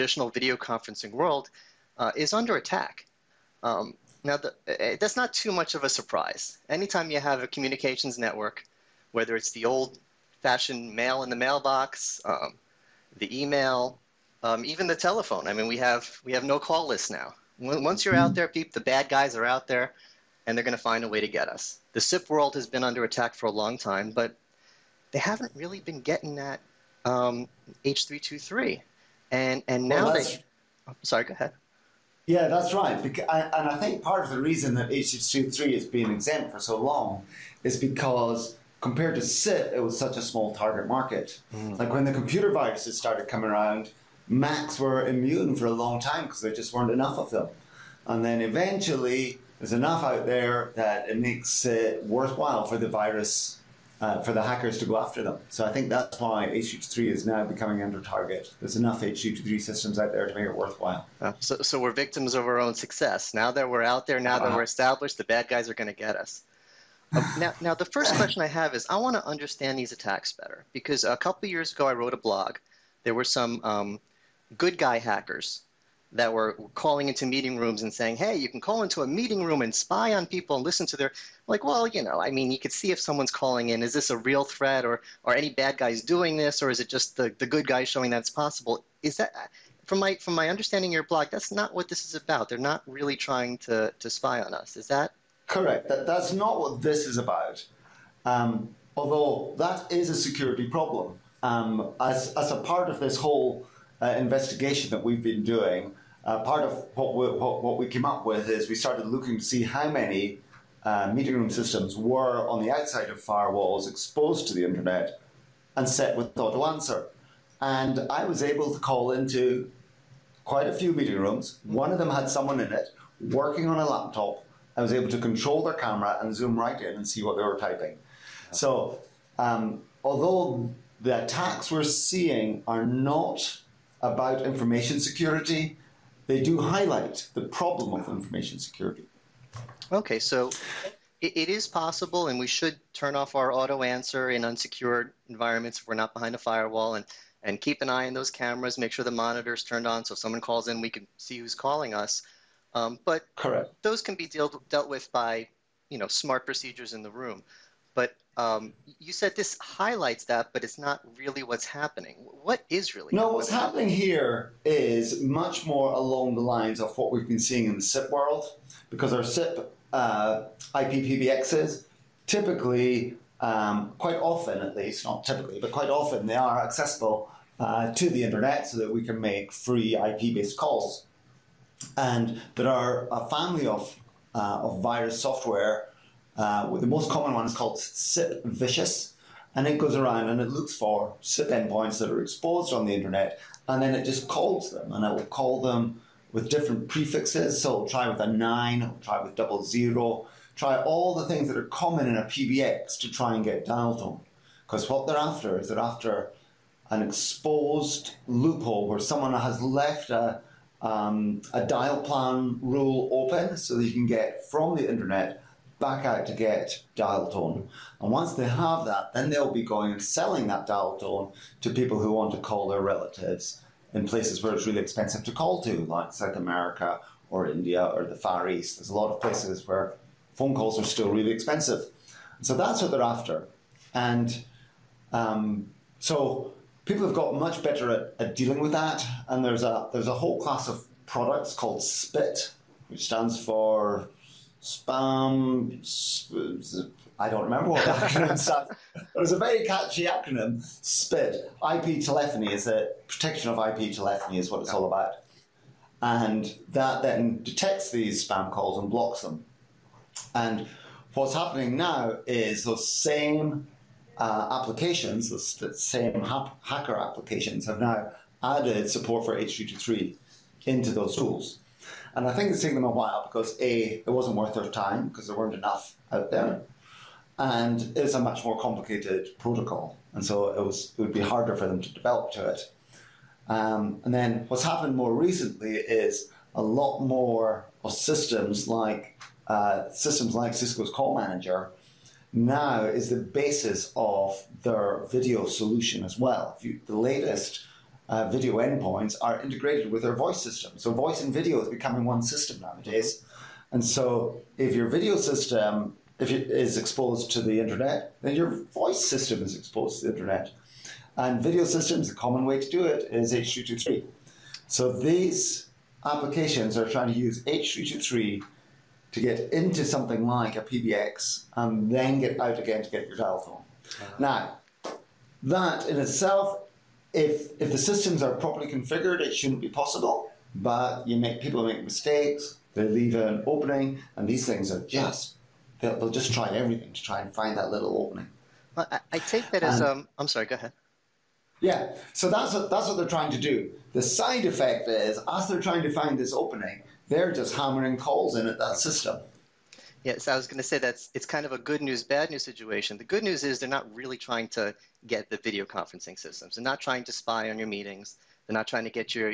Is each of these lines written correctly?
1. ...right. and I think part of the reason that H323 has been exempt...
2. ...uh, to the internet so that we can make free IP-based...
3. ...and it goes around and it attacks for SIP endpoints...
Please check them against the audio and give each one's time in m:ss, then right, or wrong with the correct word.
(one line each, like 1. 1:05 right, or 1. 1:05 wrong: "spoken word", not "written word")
1. 0:32 right
2. 2:57 right
3. 3:09 wrong: "looks", not "attacks".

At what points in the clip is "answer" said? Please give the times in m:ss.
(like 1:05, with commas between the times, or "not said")
1:56, 2:23.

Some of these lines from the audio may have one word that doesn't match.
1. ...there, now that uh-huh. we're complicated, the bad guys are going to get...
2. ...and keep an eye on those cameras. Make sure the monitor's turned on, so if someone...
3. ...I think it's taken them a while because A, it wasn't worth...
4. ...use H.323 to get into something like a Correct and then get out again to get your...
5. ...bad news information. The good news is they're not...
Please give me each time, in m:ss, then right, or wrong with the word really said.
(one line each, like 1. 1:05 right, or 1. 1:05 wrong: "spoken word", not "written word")
1. 1:04 wrong: "established", not "complicated"
2. 2:27 right
3. 4:32 right
4. 5:17 wrong: "PBX", not "Correct"
5. 5:52 wrong: "situation", not "information".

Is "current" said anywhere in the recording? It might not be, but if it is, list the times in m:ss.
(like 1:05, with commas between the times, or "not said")
not said.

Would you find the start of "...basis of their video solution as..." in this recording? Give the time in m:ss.
4:53.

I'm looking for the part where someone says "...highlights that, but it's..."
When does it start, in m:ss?
2:39.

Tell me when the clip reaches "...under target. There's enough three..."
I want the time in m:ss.
0:57.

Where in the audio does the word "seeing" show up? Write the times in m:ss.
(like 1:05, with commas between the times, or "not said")
2:11, 2:47.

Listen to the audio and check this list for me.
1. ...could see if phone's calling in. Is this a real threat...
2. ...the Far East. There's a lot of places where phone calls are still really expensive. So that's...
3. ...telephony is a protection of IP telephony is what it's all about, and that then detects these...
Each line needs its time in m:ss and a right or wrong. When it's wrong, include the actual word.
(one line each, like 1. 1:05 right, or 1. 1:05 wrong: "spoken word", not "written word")
1. 1:22 wrong: "someone", not "phone"
2. 3:48 right
3. 4:12 right.